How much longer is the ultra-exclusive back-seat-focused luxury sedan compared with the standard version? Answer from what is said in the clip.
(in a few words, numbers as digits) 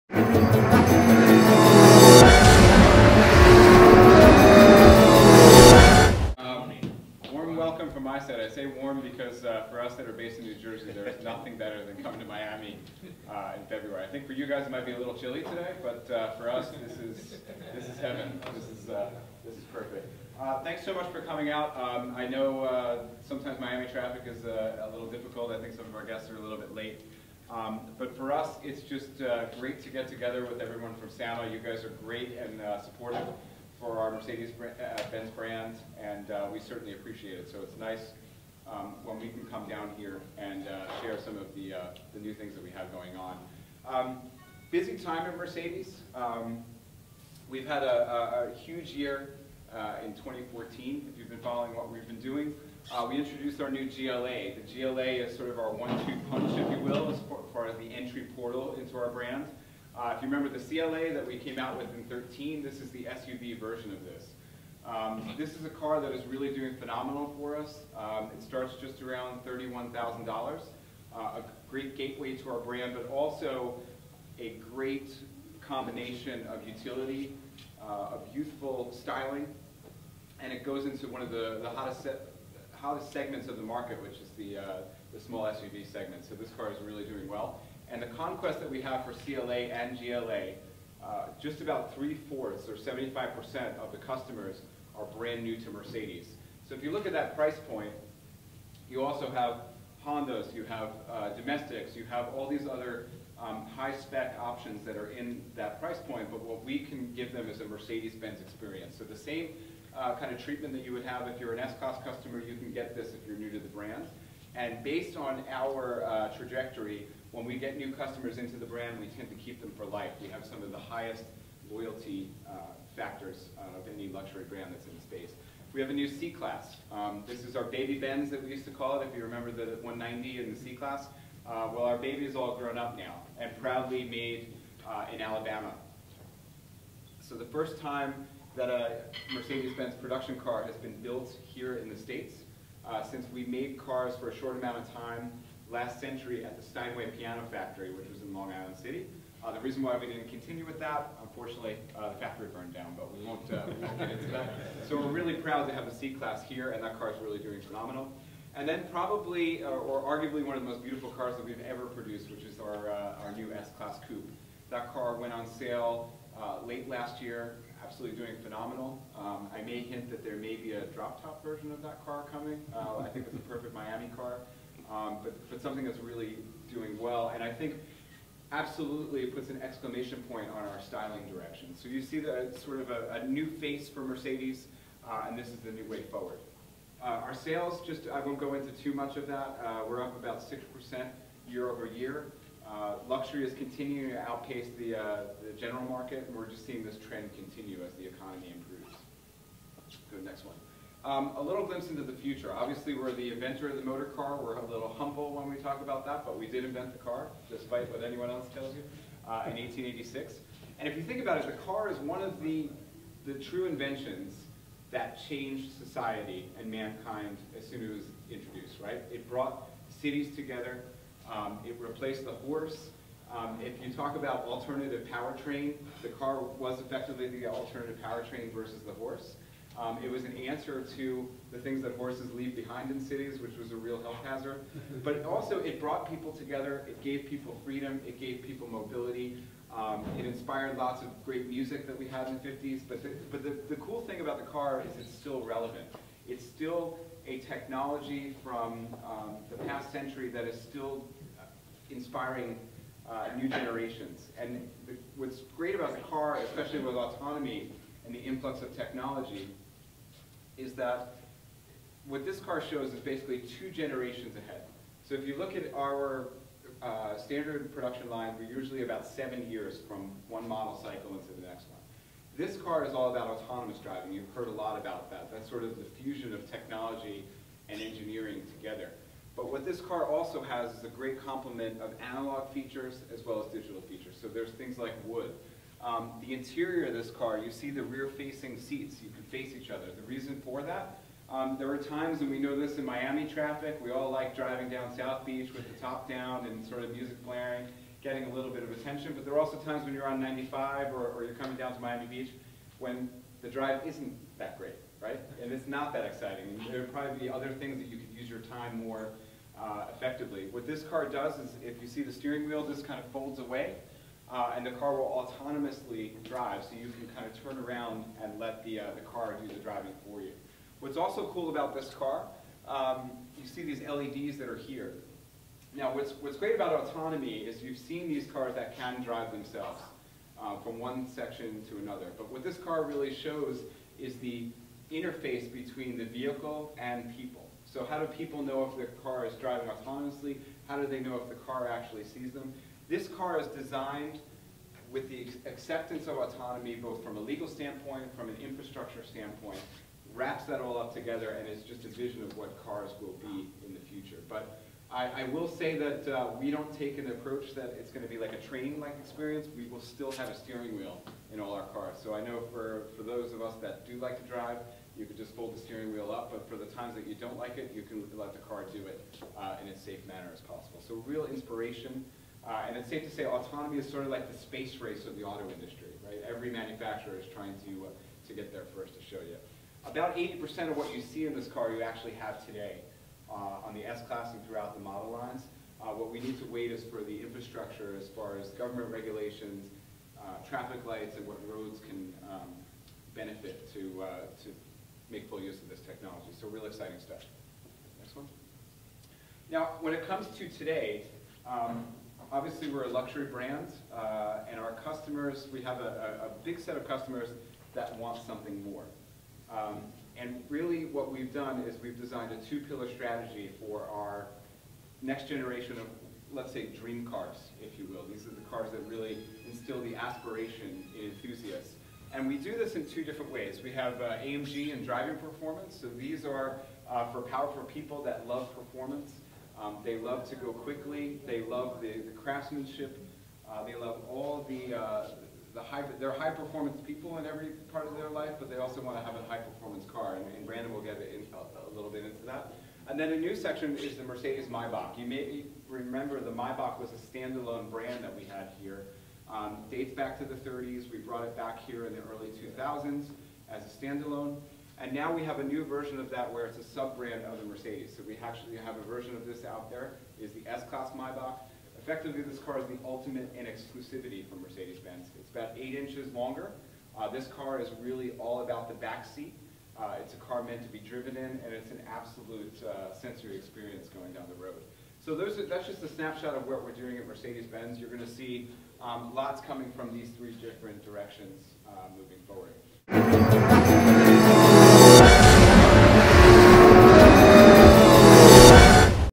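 eight inches.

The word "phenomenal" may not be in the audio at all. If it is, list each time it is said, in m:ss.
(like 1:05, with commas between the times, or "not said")
1:06, 2:37, 2:48.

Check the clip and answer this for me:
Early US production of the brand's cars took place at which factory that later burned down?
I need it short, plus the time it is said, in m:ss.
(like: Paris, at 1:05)
Steinway Piano Factory, at 2:26.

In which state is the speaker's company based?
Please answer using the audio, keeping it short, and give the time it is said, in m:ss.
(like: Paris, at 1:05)
New Jersey, at 0:10.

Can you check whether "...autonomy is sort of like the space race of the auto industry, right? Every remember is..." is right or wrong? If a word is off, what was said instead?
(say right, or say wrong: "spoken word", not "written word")
wrong: "manufacturer", not "remember".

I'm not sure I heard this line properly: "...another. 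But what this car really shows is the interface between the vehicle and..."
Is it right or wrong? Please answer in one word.
right.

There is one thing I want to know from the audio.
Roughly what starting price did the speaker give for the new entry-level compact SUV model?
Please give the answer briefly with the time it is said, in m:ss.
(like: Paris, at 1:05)
$31,000, at 1:09.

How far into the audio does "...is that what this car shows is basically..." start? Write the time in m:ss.
4:20.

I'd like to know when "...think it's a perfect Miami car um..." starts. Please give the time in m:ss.
2:53.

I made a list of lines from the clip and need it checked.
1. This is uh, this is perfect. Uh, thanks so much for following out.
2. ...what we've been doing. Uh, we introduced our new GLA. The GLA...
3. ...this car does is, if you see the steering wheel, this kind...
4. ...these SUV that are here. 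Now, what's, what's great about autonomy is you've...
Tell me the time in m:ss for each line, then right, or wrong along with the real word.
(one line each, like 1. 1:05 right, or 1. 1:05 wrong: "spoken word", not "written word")
1. 0:18 wrong: "coming", not "following"
2. 0:51 right
3. 5:10 right
4. 5:23 wrong: "LEDs", not "SUV".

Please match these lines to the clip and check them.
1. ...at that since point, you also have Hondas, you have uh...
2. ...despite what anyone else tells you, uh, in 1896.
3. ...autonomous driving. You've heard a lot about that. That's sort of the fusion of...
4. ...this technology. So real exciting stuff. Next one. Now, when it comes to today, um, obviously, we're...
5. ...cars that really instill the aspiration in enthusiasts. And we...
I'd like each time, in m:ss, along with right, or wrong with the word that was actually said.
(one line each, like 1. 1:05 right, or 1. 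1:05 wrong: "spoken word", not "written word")
1. 1:37 wrong: "price", not "since"
2. 3:27 wrong: "1886", not "1896"
3. 4:33 right
4. 6:35 right
5. 6:58 right.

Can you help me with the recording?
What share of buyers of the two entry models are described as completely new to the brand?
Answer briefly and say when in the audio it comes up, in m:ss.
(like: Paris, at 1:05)
75%, at 1:32.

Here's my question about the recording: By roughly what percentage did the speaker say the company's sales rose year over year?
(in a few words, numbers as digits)
6%.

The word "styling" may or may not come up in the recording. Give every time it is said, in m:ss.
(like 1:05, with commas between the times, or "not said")
1:18, 3:00.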